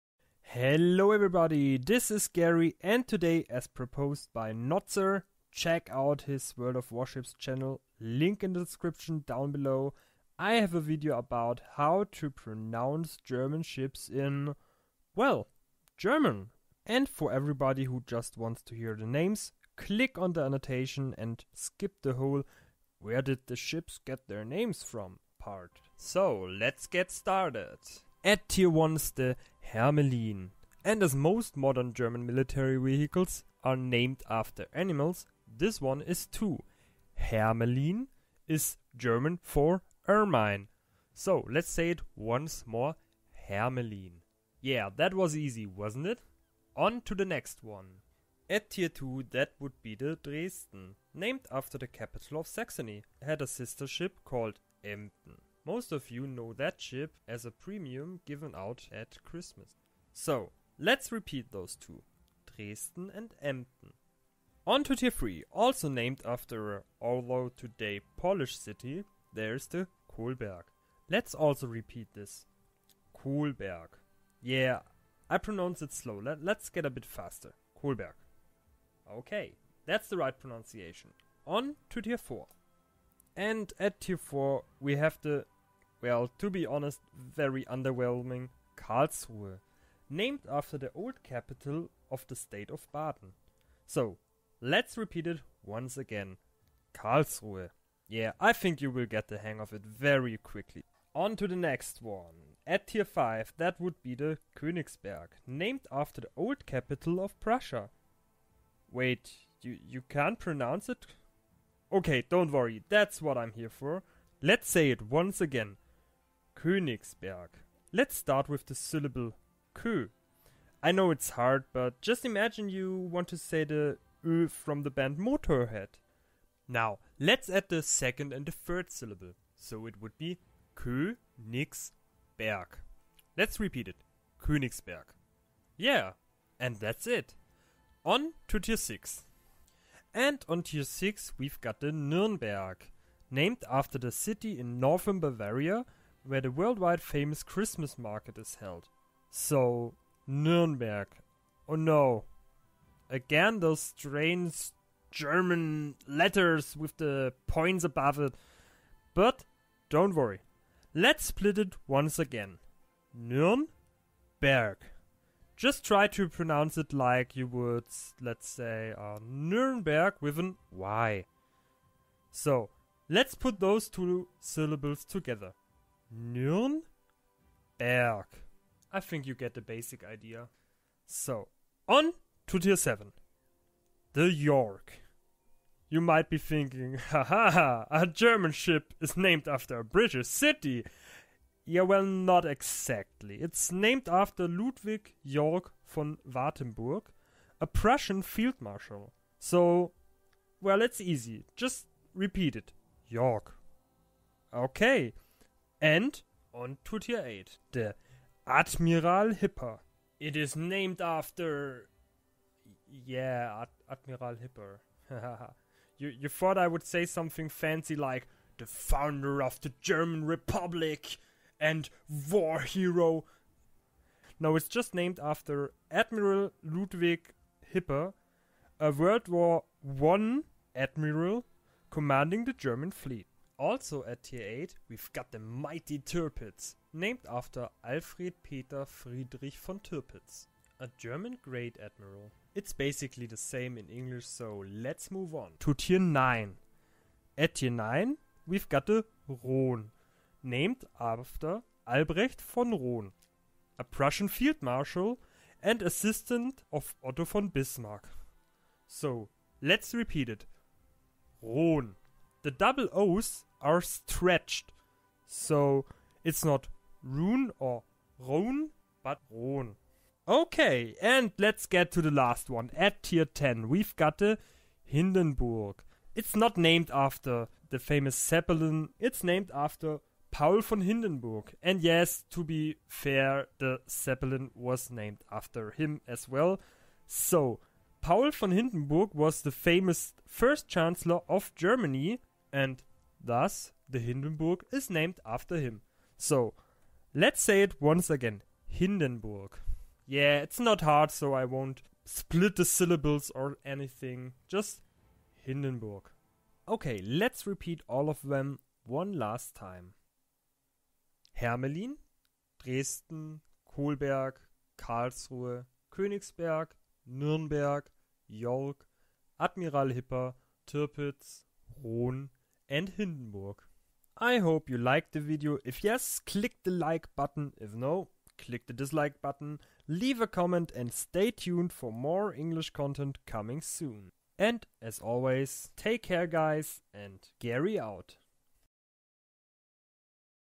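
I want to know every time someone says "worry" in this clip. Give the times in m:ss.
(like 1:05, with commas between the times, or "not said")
1:52, 2:40.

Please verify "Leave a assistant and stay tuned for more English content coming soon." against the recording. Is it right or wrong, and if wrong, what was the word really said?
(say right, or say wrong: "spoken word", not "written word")
wrong: "comment", not "assistant".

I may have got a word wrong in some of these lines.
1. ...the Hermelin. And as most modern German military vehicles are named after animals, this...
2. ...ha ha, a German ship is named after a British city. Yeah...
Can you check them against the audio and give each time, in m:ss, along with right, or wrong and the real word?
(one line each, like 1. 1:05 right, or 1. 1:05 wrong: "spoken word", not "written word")
1. 0:29 right
2. 3:06 right.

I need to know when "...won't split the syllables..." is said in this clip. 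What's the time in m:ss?
5:01.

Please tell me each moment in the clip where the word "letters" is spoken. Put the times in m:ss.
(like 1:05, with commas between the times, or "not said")
2:36.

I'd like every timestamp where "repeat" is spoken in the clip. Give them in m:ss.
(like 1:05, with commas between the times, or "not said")
1:01, 1:11, 1:34, 2:13, 3:22, 4:19, 5:07.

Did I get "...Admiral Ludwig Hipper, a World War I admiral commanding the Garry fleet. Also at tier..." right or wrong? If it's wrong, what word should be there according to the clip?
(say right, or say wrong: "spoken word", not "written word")
wrong: "German", not "Garry".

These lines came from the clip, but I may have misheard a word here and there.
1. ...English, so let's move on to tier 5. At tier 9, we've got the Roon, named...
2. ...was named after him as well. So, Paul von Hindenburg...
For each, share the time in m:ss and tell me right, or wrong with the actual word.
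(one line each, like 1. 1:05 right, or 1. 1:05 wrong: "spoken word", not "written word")
1. 4:03 wrong: "9", not "5"
2. 4:44 right.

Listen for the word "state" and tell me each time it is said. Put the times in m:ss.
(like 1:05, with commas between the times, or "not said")
1:32.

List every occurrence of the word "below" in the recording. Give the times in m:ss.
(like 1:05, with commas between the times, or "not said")
0:09.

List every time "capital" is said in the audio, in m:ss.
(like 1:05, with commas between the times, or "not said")
0:51, 1:31, 1:46.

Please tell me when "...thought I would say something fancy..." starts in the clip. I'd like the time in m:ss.
3:36.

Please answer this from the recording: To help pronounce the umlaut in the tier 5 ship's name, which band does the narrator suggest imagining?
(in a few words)
Motorhead.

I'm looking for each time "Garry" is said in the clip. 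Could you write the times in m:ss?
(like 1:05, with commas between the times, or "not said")
0:02, 5:37.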